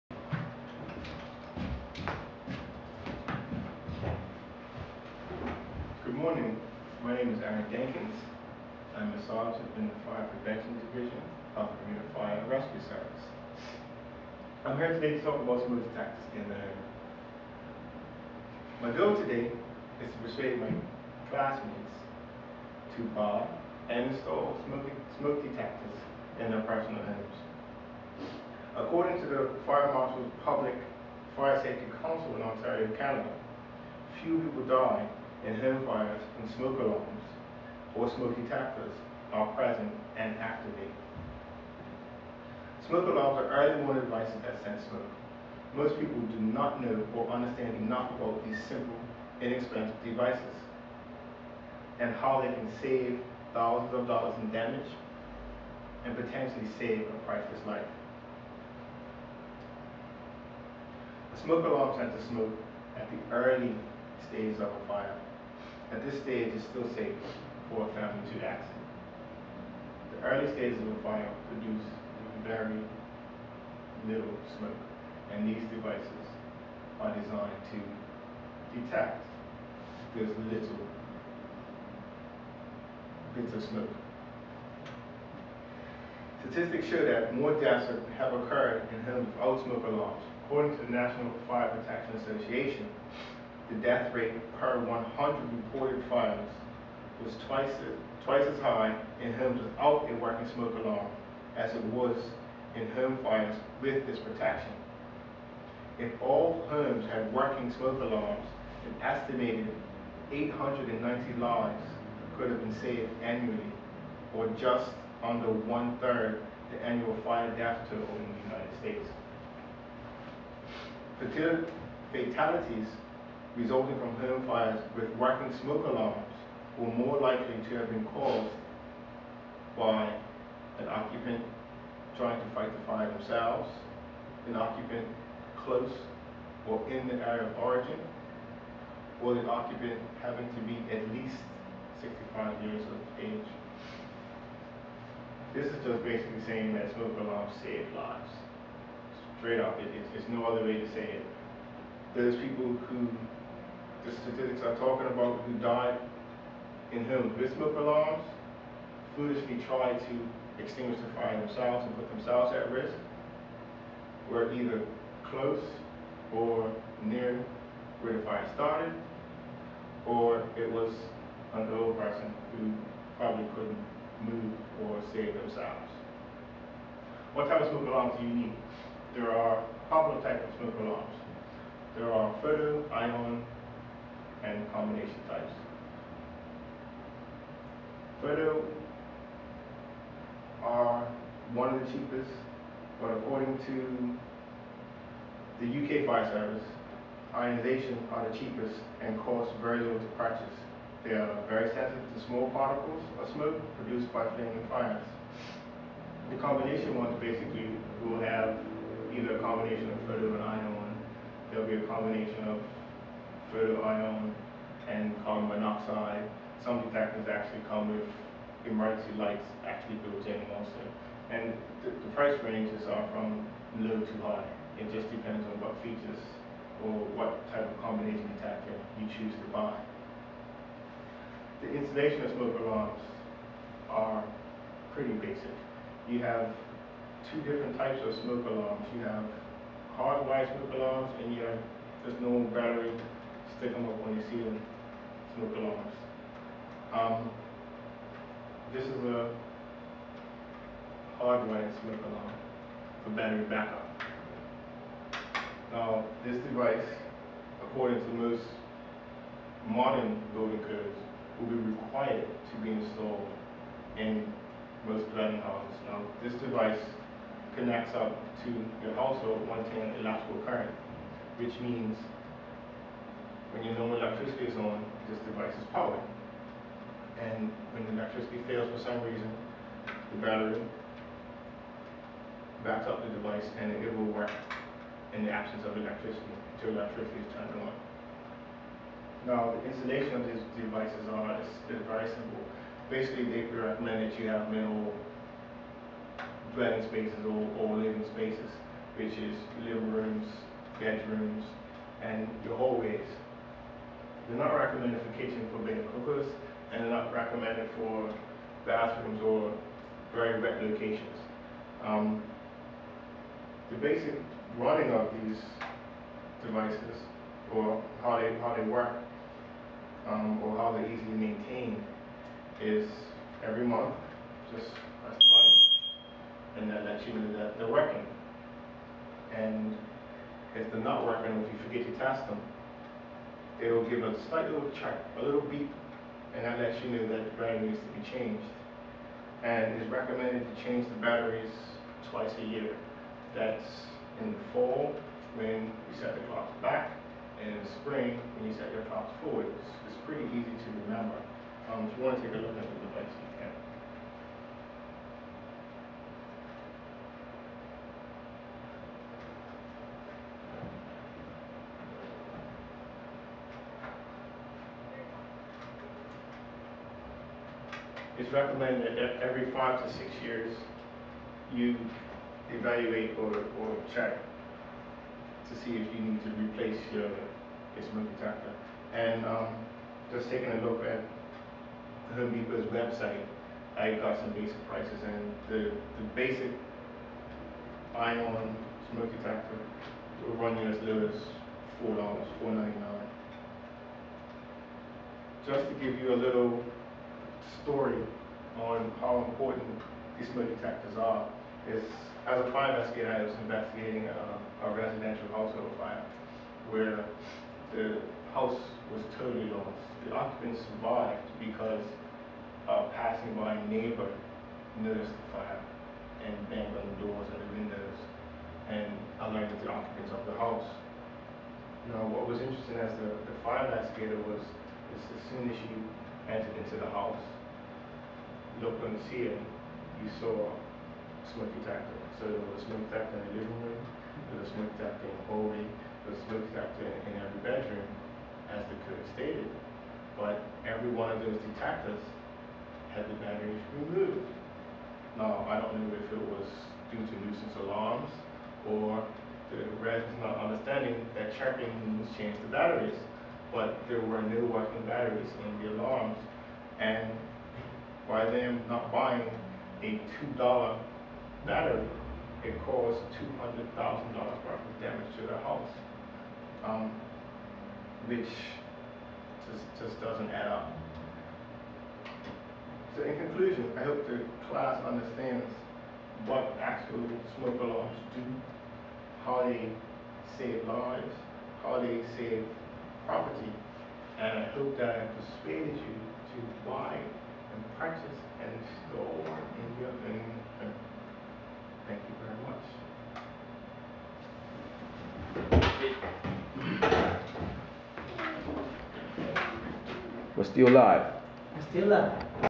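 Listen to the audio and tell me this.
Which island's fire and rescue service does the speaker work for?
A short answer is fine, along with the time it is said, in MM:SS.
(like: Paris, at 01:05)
Bermuda, at 00:11.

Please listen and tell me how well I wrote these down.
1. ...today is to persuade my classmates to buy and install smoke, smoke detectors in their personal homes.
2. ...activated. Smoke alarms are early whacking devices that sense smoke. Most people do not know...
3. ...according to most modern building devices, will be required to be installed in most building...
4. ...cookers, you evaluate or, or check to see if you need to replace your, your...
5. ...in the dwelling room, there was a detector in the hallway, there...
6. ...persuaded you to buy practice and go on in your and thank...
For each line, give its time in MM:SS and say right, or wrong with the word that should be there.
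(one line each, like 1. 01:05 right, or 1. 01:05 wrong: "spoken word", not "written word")
1. 00:19 right
2. 00:40 wrong: "warning", not "whacking"
3. 04:17 wrong: "codes", not "devices"
4. 06:10 wrong: "years", not "cookers"
5. 07:13 wrong: "living", not "dwelling"
6. 08:05 right.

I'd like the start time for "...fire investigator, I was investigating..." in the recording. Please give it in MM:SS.
06:42.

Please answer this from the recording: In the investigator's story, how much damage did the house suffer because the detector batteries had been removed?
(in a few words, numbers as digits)
$200,000.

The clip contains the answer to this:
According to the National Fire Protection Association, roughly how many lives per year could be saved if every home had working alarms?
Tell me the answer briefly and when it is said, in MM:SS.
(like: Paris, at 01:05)
890, at 01:50.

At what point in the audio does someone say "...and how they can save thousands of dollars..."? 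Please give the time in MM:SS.
00:51.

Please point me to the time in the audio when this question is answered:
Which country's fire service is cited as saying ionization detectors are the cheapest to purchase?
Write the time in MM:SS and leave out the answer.
03:15.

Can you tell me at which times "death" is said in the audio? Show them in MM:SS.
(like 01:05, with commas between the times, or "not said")
01:27, 01:33, 01:57.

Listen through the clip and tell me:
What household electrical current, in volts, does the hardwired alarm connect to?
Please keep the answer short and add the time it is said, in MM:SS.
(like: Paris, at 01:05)
110, at 04:29.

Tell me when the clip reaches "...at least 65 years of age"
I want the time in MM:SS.
02:20.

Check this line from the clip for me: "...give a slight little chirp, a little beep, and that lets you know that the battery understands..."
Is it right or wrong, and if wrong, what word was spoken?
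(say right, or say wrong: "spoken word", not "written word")
wrong: "needs", not "understands".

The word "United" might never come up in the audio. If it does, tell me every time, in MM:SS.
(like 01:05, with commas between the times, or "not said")
01:58.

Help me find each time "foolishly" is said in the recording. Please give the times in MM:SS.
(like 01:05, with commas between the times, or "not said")
02:39.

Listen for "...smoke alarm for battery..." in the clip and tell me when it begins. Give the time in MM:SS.
04:11.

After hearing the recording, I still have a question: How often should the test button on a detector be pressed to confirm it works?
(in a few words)
every month.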